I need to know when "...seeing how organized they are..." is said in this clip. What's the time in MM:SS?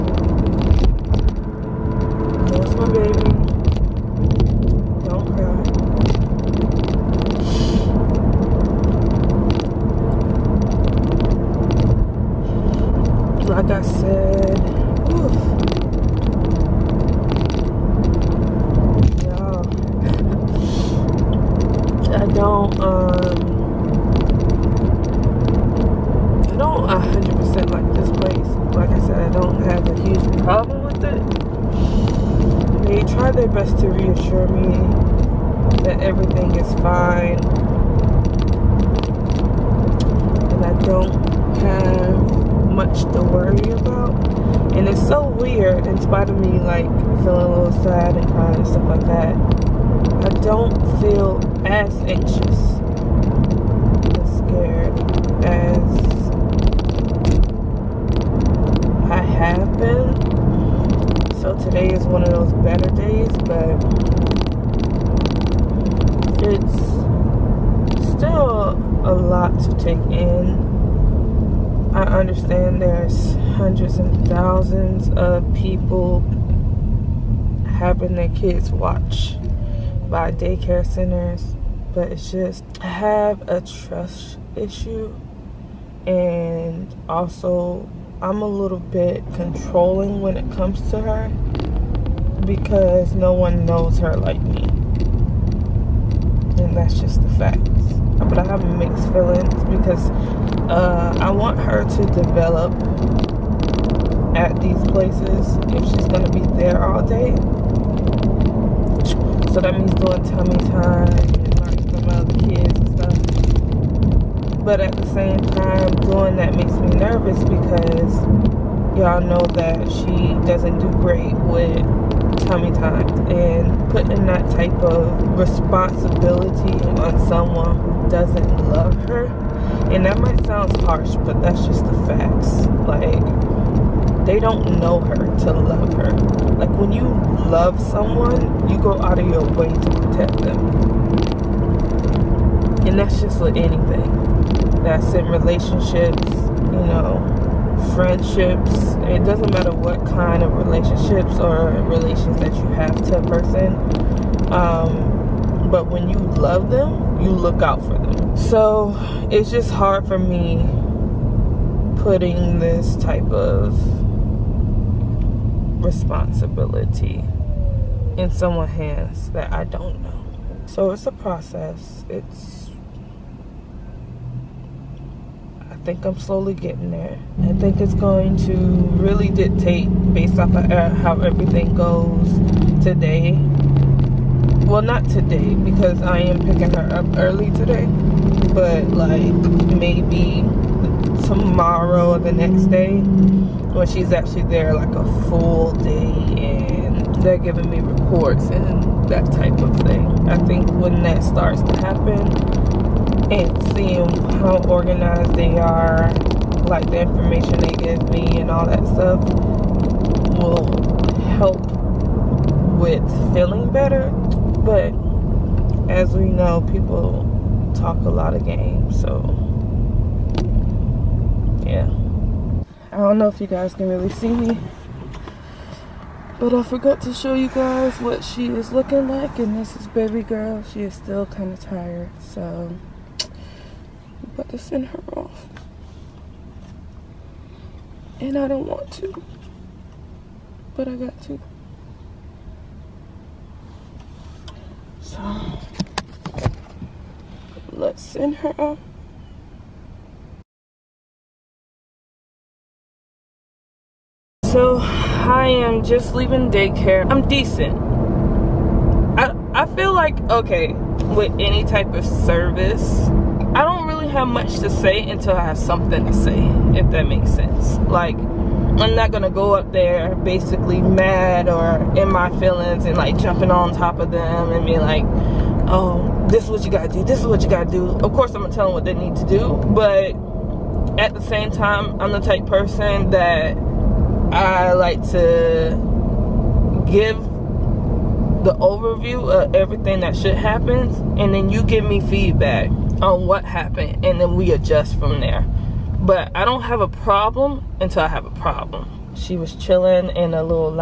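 03:23.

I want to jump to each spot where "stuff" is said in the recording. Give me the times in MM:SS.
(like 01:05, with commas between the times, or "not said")
01:52, 03:28.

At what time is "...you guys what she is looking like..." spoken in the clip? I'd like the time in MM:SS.
03:47.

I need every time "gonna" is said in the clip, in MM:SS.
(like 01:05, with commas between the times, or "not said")
01:46, 04:29, 04:38.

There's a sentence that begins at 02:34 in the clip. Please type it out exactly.
Um, but when you love them, you look out for them.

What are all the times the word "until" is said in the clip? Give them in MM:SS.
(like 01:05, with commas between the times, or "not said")
04:25, 04:57.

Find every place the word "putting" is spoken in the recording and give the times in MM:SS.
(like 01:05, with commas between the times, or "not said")
02:03, 02:42.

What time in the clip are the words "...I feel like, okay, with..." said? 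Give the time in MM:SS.
04:19.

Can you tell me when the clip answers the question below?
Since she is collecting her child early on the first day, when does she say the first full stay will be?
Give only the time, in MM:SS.
03:11.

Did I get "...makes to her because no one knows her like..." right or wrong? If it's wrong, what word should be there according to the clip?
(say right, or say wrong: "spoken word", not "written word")
wrong: "comes", not "makes".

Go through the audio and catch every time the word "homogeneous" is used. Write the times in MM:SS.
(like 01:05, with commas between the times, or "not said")
not said.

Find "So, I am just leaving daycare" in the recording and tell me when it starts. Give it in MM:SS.
04:14.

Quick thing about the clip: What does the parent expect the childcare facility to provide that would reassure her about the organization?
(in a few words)
reports.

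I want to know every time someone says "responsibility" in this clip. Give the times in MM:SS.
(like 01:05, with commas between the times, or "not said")
02:05, 02:45.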